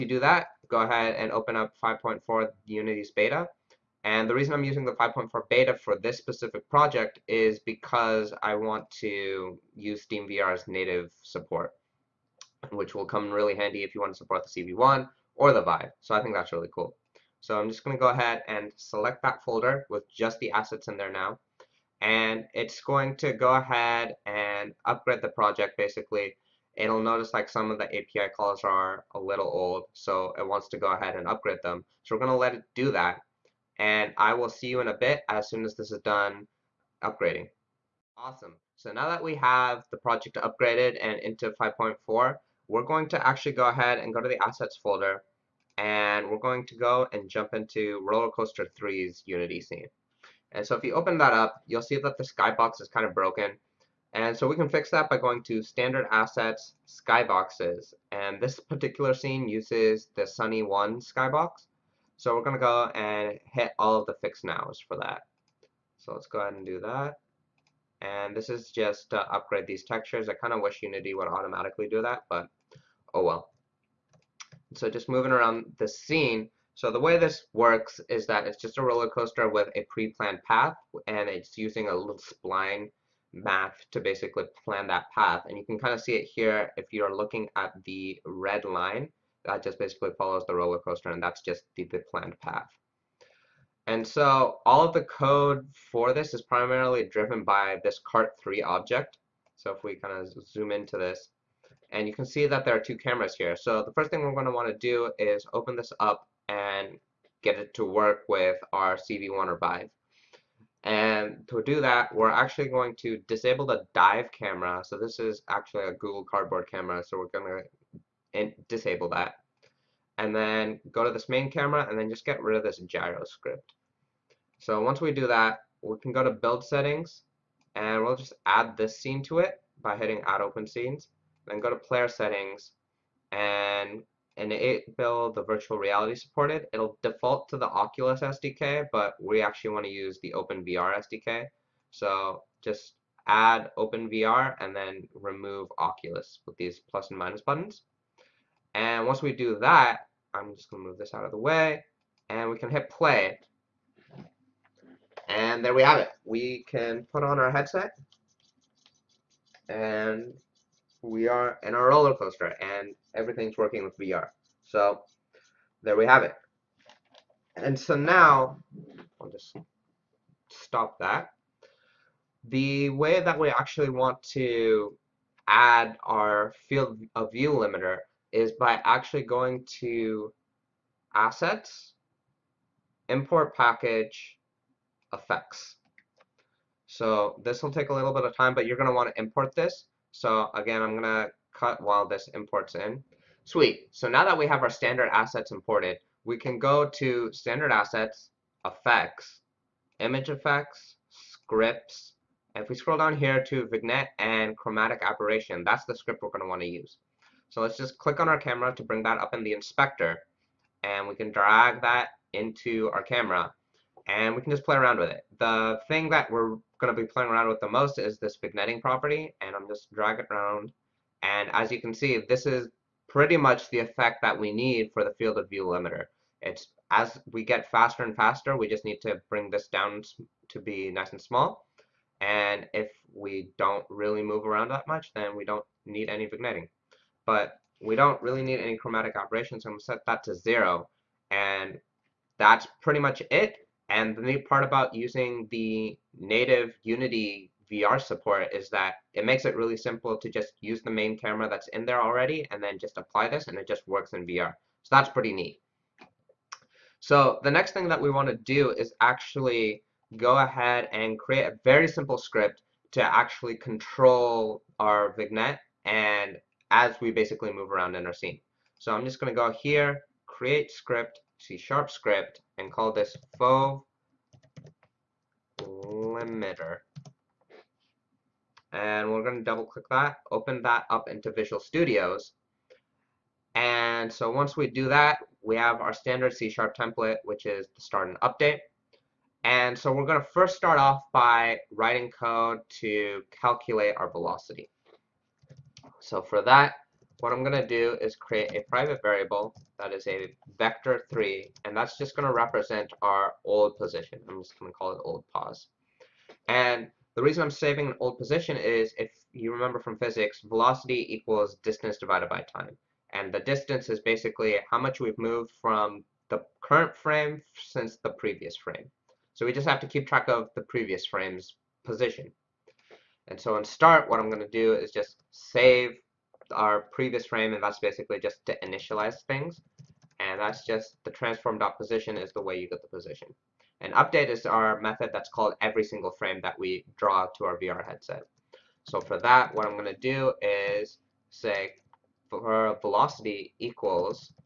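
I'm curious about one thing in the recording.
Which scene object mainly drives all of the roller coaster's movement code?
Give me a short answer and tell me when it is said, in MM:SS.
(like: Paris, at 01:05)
cart3, at 01:38.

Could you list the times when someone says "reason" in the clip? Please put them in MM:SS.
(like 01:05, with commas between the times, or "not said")
00:04, 05:07.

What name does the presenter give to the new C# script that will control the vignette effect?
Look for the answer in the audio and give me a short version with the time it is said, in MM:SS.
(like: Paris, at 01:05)
fov limiter, at 04:33.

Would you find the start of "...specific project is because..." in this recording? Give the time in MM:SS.
00:06.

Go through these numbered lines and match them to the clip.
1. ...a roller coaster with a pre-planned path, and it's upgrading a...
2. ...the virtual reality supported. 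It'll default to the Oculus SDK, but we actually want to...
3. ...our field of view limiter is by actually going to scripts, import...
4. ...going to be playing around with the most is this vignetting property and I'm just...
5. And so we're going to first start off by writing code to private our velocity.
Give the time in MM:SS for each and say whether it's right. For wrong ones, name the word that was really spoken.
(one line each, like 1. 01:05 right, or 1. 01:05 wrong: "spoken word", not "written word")
1. 01:18 wrong: "using", not "upgrading"
2. 02:15 right
3. 02:56 wrong: "assets", not "scripts"
4. 03:36 right
5. 04:49 wrong: "calculate", not "private".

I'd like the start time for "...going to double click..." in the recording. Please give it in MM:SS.
04:39.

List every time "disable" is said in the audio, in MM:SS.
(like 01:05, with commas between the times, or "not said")
01:53, 01:58.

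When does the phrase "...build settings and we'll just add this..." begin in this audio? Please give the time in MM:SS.
02:06.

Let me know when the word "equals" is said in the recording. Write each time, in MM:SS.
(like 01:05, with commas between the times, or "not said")
05:11, 05:43.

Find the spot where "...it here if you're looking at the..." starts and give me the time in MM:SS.
01:26.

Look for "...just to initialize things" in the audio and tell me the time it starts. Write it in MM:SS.
05:28.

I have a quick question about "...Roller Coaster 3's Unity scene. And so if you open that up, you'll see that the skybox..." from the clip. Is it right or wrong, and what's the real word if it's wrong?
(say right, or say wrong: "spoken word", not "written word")
right.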